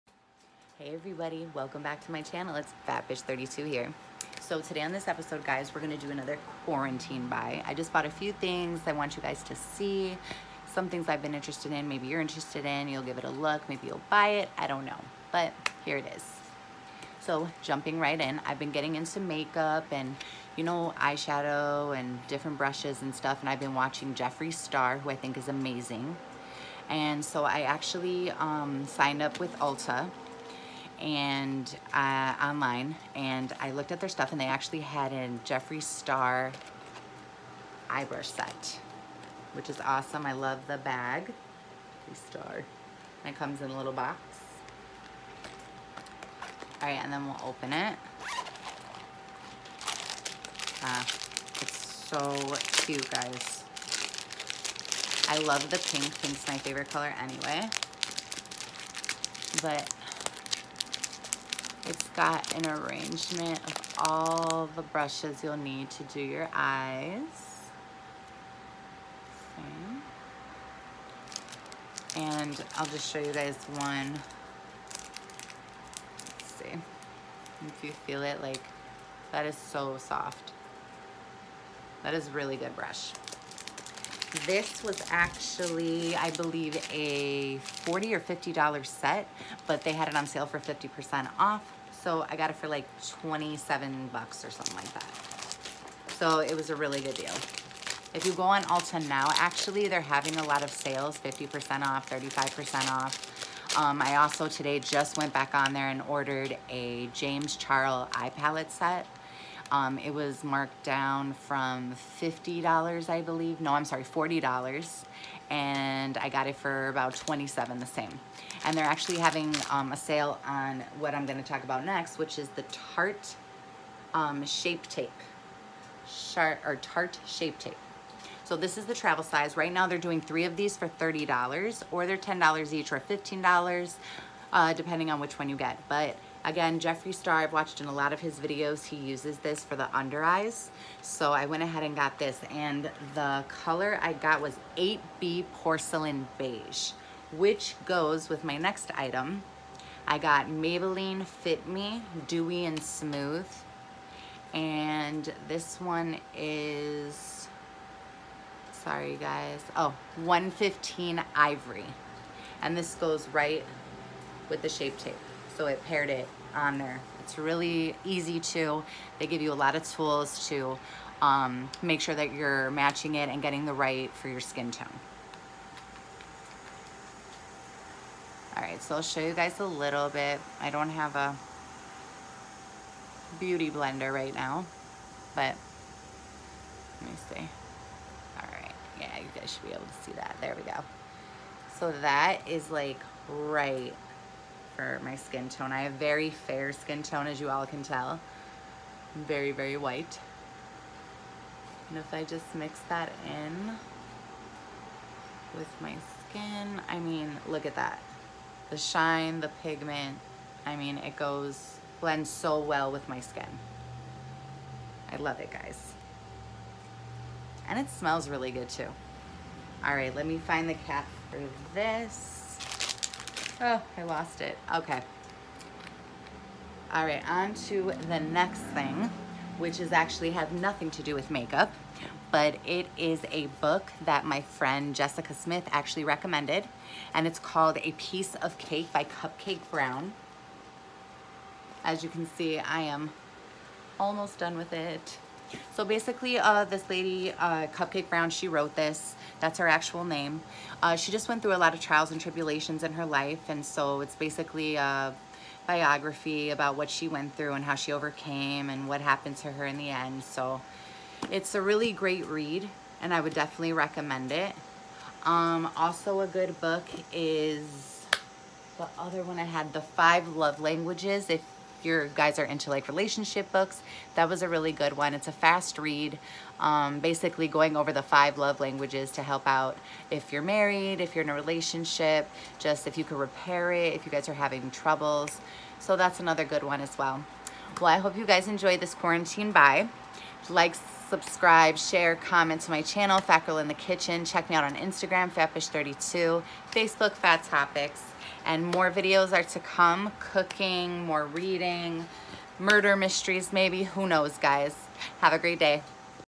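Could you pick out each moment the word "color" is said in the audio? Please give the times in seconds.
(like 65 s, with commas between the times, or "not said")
56 s, 143 s.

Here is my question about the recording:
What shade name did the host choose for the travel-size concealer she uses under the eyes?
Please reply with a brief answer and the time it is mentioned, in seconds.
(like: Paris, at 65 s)
8B Porcelain Beige, at 144 s.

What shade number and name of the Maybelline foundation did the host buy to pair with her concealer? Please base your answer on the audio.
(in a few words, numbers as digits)
115 Ivory.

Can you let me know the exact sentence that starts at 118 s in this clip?
And they're actually having um, a sale on what I'm gonna talk about next, which is the Tarte um, Shape Tape.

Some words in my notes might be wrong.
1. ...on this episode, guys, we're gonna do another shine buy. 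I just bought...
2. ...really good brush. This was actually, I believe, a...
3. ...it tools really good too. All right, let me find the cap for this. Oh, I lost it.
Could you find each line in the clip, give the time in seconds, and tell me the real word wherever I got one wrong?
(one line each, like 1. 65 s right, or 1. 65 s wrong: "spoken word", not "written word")
1. 4 s wrong: "quarantine", not "shine"
2. 82 s right
3. 217 s wrong: "smells", not "tools".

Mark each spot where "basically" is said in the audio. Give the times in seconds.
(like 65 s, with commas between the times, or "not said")
245 s, 254 s, 276 s.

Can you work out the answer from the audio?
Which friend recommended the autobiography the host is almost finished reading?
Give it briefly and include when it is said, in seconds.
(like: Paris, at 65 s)
Jessica Smith, at 234 s.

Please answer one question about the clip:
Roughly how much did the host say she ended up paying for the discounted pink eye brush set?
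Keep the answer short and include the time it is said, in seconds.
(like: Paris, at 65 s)
$27, at 93 s.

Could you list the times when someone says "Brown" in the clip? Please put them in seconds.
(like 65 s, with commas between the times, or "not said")
239 s, 248 s.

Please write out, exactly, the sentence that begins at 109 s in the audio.
Um, it was marked down from $50, I believe.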